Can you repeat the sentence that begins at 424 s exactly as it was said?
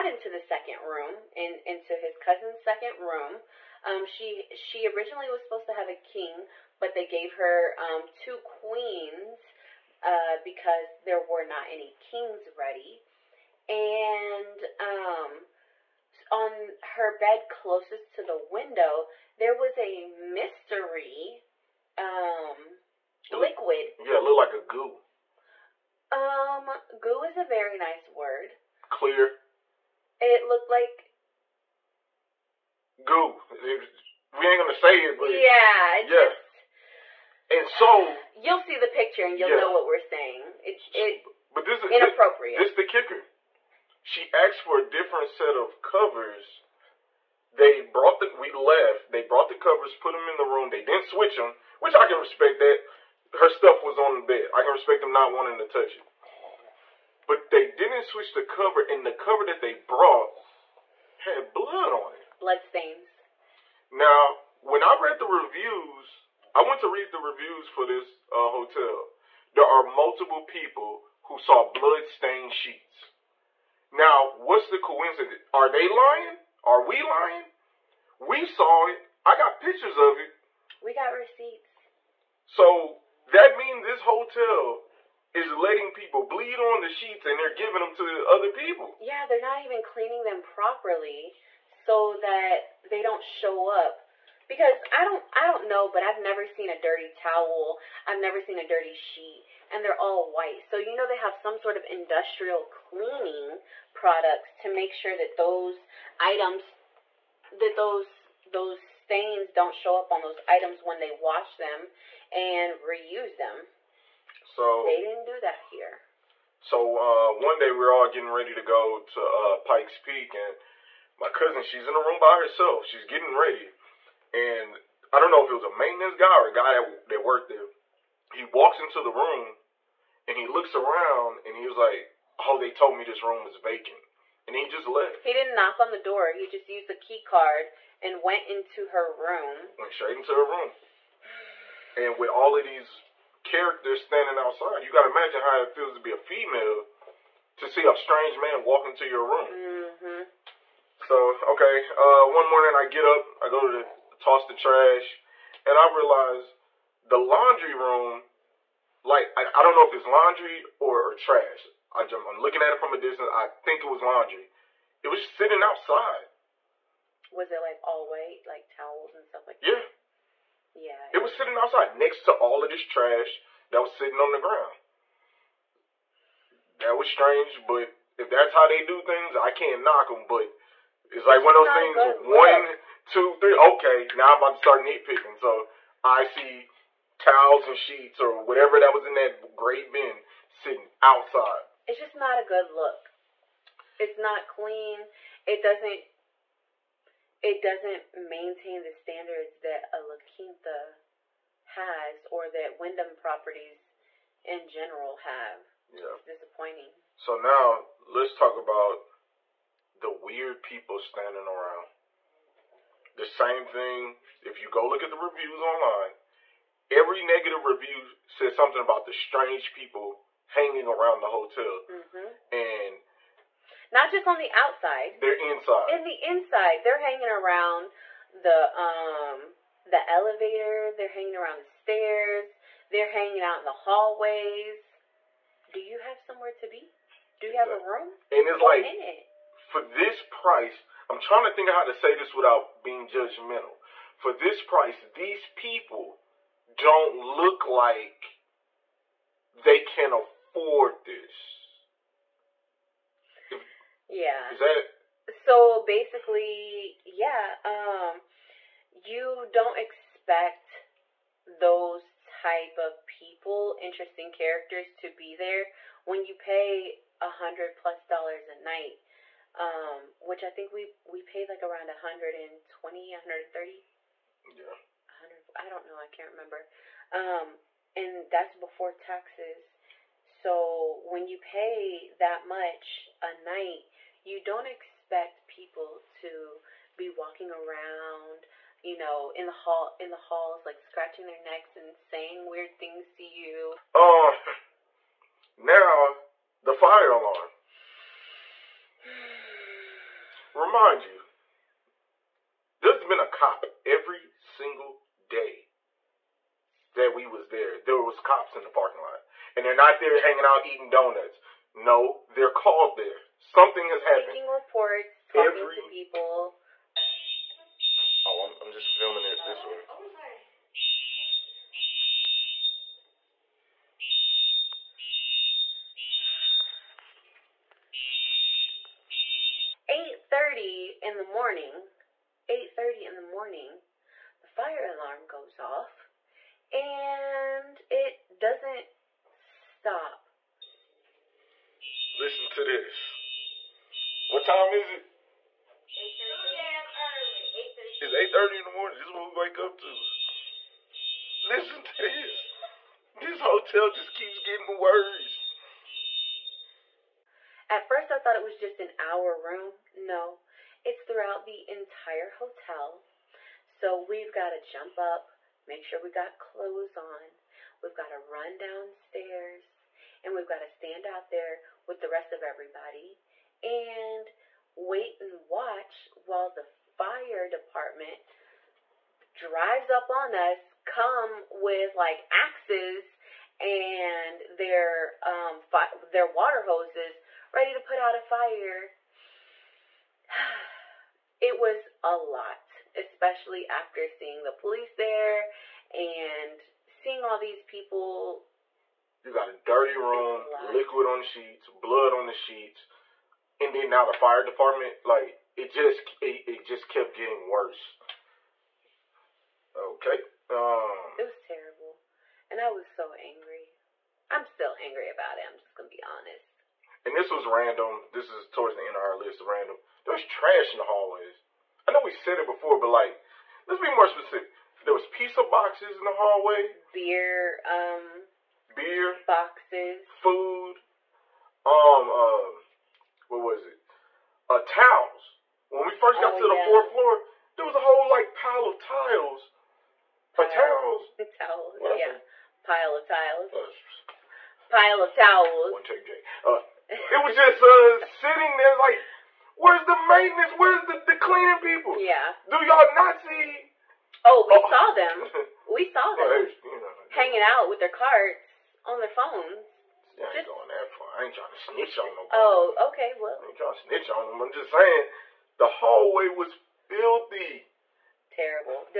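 There was pizza boxes in the hallway.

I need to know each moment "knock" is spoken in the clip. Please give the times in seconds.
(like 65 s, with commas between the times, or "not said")
135 s, 179 s.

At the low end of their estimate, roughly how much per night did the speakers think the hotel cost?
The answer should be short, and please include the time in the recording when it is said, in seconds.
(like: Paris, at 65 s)
120, at 271 s.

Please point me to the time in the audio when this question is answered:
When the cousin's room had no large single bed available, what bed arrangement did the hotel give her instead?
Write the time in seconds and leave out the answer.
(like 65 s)
8 s.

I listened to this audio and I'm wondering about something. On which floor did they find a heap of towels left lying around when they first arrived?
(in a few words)
fourth floor.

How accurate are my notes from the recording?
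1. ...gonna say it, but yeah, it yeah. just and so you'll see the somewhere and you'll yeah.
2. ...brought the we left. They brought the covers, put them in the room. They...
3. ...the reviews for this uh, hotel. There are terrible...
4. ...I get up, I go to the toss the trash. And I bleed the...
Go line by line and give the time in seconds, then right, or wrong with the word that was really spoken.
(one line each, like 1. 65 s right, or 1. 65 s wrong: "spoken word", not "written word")
1. 34 s wrong: "picture", not "somewhere"
2. 47 s right
3. 67 s wrong: "multiple", not "terrible"
4. 152 s wrong: "realized", not "bleed".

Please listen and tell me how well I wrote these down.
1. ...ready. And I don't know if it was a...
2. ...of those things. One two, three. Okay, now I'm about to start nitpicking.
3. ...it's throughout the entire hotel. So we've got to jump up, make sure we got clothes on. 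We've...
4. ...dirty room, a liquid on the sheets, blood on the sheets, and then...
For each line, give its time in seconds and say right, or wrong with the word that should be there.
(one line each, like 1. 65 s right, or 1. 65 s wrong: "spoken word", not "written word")
1. 123 s right
2. 181 s right
3. 360 s right
4. 399 s right.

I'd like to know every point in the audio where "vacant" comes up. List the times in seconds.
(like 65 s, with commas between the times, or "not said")
133 s.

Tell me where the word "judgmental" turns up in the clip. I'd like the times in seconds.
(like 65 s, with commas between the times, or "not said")
243 s.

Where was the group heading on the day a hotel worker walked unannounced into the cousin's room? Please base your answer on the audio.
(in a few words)
Pikes Peak.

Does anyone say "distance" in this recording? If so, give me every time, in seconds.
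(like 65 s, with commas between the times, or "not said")
162 s.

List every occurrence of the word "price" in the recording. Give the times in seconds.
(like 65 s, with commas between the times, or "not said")
240 s, 244 s.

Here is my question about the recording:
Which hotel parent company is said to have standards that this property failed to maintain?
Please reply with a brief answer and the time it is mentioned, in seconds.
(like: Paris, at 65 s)
Wyndham, at 202 s.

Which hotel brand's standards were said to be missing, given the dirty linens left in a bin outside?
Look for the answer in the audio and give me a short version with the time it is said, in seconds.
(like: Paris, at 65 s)
La Quinta, at 200 s.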